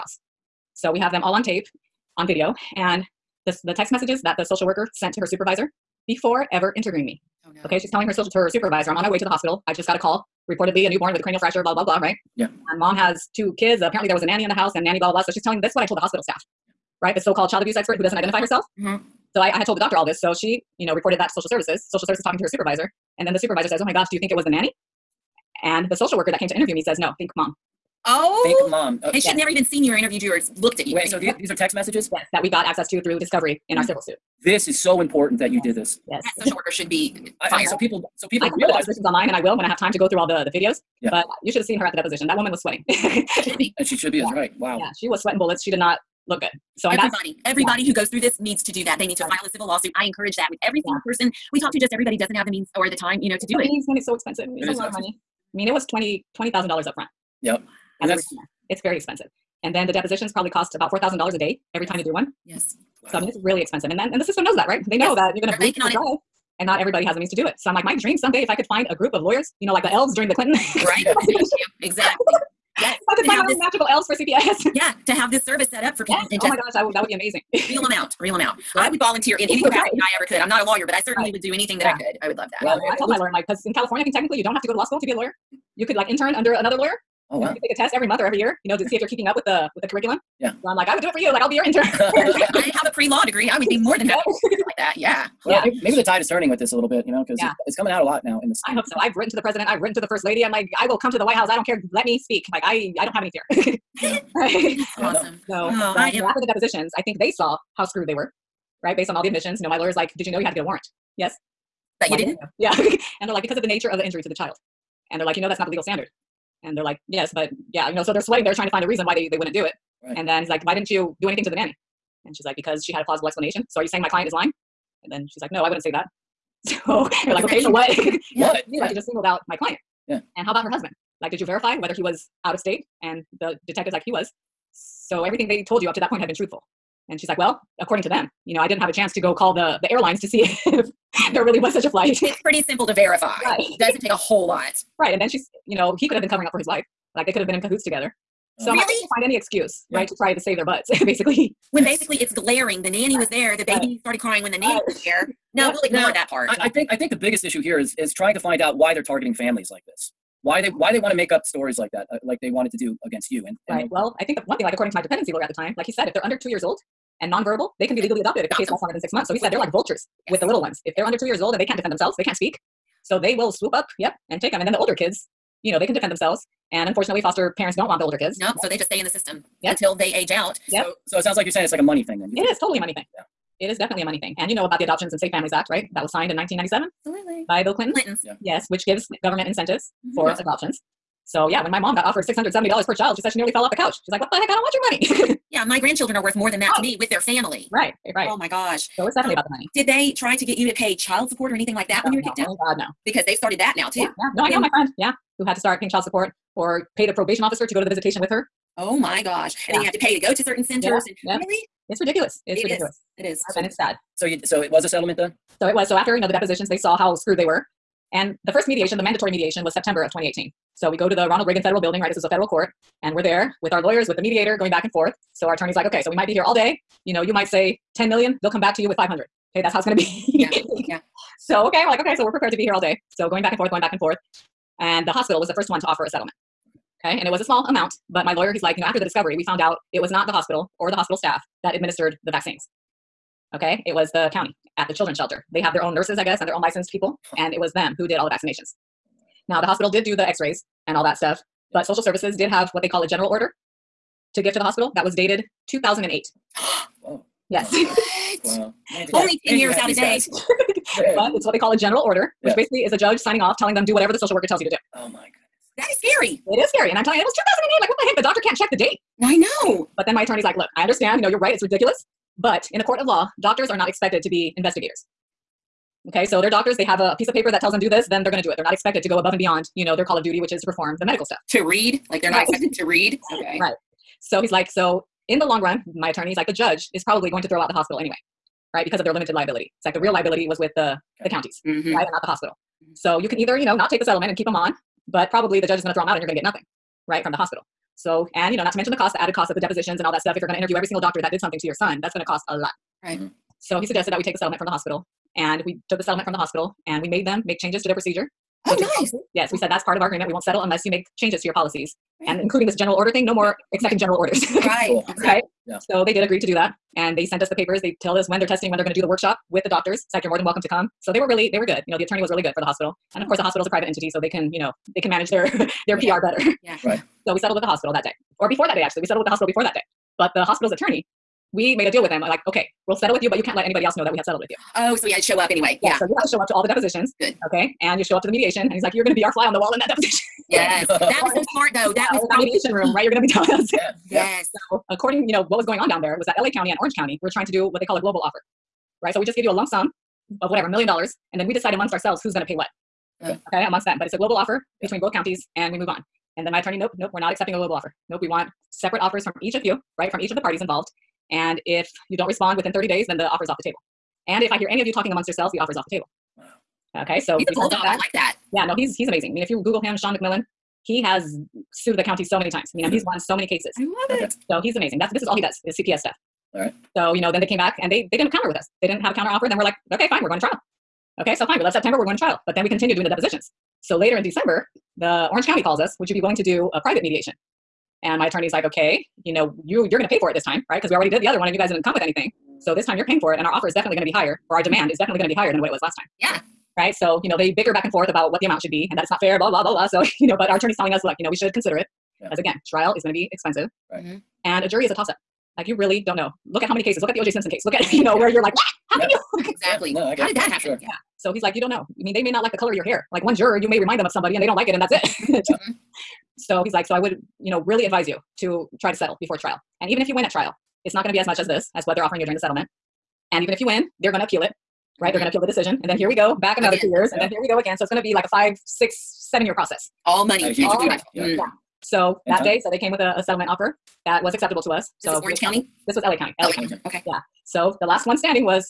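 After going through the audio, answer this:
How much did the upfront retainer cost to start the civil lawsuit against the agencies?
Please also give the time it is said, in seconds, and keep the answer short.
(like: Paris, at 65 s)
$20,000, at 56 s.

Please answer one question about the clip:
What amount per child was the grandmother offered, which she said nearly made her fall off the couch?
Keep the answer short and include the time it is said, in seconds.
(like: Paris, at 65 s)
$670, at 192 s.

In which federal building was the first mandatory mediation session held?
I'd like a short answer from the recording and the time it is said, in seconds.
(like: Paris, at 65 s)
Ronald Reagan Federal Building, at 221 s.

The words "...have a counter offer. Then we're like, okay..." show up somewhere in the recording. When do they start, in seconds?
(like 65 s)
379 s.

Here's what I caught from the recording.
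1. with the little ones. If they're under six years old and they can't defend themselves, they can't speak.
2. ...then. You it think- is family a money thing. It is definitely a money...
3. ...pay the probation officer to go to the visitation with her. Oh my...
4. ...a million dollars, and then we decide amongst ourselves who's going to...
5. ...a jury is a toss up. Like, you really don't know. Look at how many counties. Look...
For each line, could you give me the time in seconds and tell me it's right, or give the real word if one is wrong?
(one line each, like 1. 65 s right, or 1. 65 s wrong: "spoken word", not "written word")
1. 170 s wrong: "two", not "six"
2. 182 s wrong: "totally", not "family"
3. 206 s right
4. 350 s right
5. 404 s wrong: "cases", not "counties".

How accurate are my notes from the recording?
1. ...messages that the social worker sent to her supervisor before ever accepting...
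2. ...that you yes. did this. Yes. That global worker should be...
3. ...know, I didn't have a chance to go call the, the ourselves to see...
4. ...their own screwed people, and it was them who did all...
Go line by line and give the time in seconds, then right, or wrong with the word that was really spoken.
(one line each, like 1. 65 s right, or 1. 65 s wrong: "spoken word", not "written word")
1. 3 s wrong: "interviewing", not "accepting"
2. 35 s wrong: "social", not "global"
3. 138 s wrong: "airlines", not "ourselves"
4. 246 s wrong: "licensed", not "screwed".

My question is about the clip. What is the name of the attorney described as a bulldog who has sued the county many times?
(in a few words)
Shawn McMillan.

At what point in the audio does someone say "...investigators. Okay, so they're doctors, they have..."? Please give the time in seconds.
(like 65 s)
274 s.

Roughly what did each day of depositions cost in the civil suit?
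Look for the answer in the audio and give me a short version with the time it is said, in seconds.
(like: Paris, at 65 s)
$4,000, at 60 s.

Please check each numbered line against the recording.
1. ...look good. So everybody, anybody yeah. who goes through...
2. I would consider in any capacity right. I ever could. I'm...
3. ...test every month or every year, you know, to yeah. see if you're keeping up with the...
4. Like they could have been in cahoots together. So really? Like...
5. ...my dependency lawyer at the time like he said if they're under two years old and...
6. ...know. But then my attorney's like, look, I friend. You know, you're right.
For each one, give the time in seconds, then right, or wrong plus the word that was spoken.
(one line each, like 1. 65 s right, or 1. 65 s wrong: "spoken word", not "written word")
1. 46 s wrong: "everybody", not "anybody"
2. 78 s wrong: "volunteer", not "consider"
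3. 87 s right
4. 147 s right
5. 164 s right
6. 269 s wrong: "understand", not "friend".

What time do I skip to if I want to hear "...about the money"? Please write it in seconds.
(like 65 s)
199 s.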